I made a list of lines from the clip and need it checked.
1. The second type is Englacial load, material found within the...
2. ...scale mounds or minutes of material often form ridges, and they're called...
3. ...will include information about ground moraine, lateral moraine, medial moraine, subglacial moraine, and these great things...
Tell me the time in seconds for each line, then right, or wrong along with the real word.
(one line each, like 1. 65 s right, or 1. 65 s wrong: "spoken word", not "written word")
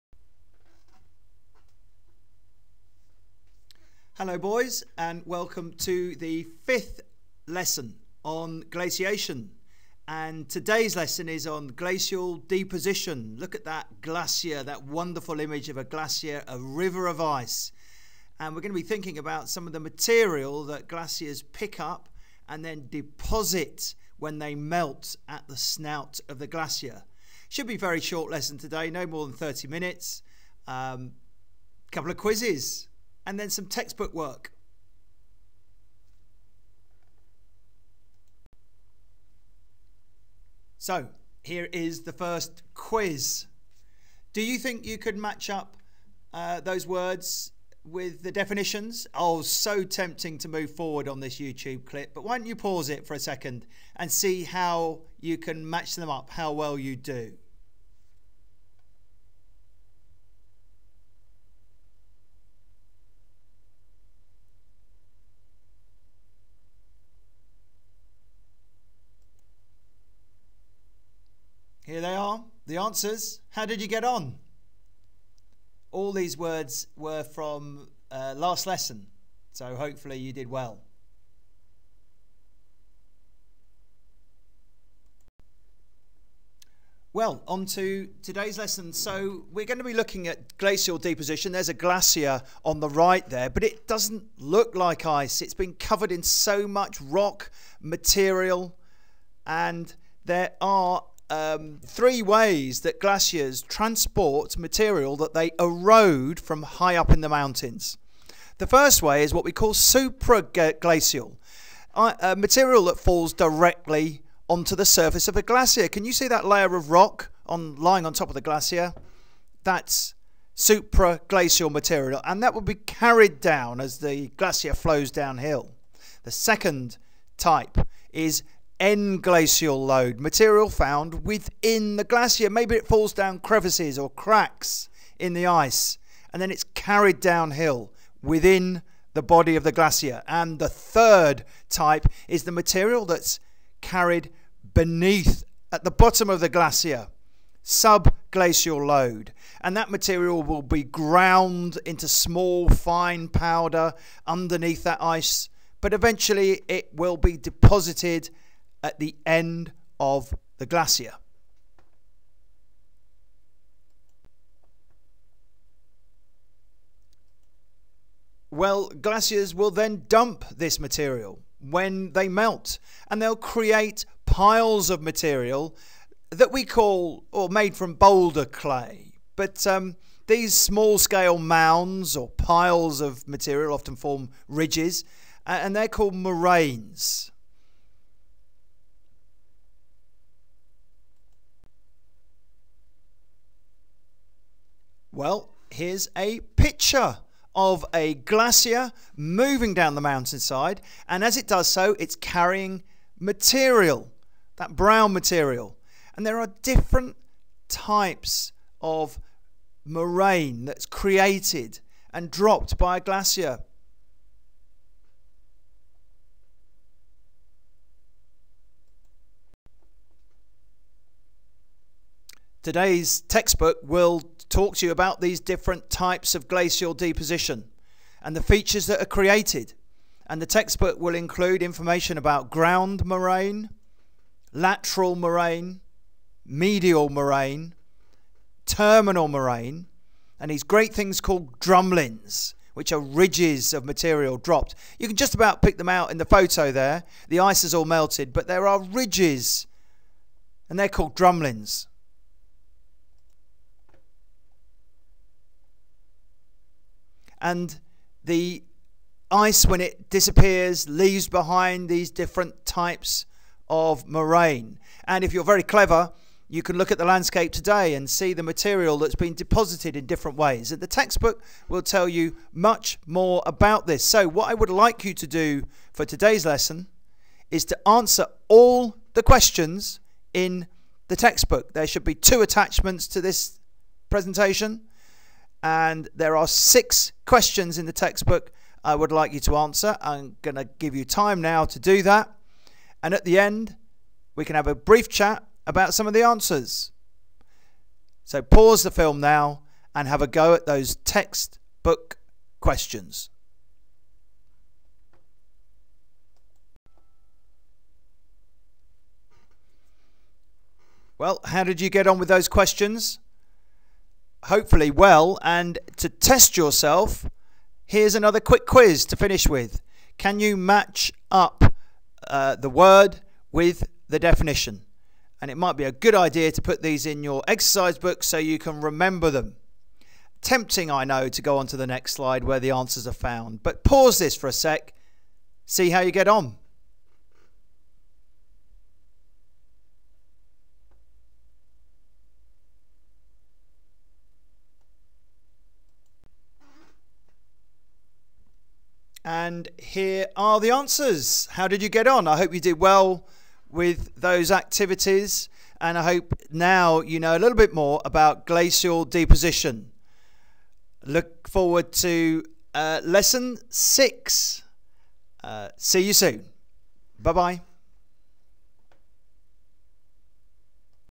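1. 126 s right
2. 180 s wrong: "piles", not "minutes"
3. 230 s wrong: "terminal", not "subglacial".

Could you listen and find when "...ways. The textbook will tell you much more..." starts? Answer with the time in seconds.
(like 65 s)
270 s.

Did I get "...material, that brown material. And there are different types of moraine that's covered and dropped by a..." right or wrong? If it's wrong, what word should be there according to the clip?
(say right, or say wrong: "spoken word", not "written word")
wrong: "created", not "covered".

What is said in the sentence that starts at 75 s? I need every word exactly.
All these words were from uh, last lesson, so hopefully you did well.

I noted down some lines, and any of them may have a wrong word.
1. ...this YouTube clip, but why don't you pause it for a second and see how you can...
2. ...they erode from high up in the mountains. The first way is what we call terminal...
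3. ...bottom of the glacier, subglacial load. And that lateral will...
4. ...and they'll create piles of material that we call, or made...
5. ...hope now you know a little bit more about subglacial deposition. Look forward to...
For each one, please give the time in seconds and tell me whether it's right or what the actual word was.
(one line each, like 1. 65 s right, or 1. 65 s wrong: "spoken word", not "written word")
1. 51 s right
2. 105 s wrong: "supraglacial", not "terminal"
3. 145 s wrong: "material", not "lateral"
4. 173 s right
5. 356 s wrong: "glacial", not "subglacial".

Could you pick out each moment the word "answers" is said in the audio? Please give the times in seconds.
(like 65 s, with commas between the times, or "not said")
72 s, 277 s, 289 s, 296 s, 332 s, 350 s.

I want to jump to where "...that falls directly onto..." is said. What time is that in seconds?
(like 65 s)
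112 s.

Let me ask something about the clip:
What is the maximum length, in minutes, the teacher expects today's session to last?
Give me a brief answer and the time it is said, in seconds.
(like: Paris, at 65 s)
30, at 29 s.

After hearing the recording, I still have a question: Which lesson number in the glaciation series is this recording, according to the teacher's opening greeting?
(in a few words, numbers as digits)
5th.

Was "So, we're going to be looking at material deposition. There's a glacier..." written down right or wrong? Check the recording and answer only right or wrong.
wrong.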